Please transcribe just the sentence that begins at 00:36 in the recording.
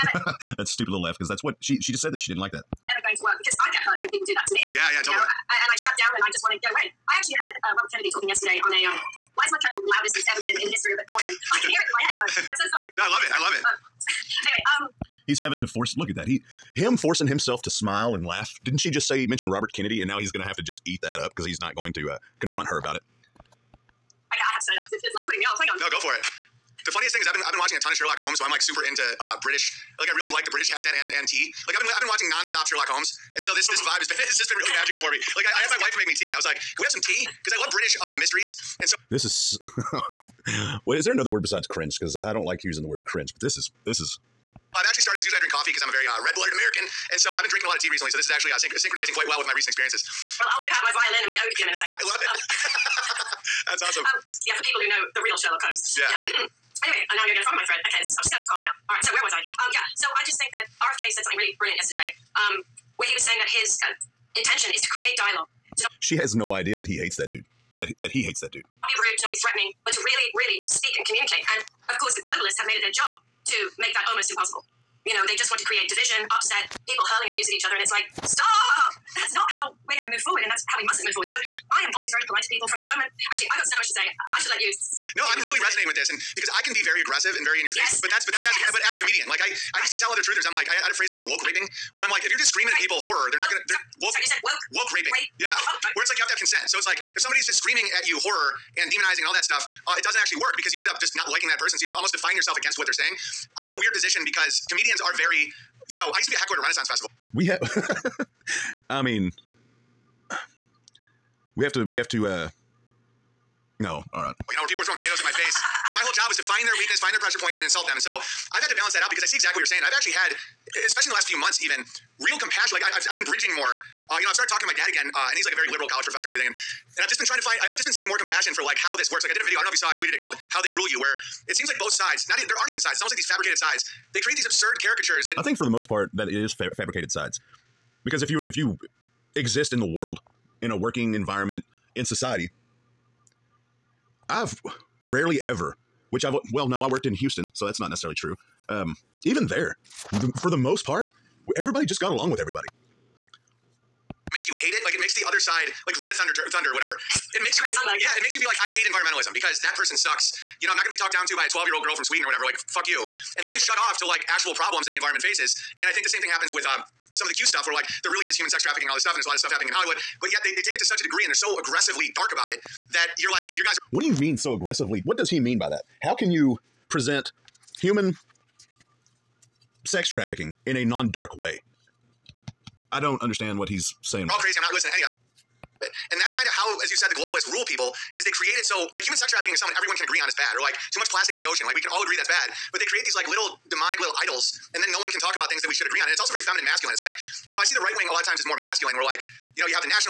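I was like, "Can we have some tea?" Because I love British uh, mysteries.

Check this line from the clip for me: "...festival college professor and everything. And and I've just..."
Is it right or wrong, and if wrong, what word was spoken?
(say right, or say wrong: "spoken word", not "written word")
wrong: "liberal", not "festival".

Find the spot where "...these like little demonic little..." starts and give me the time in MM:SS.
03:13.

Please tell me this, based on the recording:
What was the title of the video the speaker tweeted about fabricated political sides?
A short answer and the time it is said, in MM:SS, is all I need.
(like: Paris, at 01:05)
How They Rule You, at 02:10.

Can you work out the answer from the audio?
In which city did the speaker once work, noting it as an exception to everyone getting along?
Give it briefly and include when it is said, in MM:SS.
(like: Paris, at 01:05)
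Houston, at 02:27.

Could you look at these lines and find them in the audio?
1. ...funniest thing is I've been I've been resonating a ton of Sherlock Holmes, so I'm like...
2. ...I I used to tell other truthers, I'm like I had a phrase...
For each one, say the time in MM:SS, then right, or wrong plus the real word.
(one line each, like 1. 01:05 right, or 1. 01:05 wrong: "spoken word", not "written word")
1. 00:26 wrong: "watching", not "resonating"
2. 01:29 right.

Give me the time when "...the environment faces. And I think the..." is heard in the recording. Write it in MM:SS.
02:44.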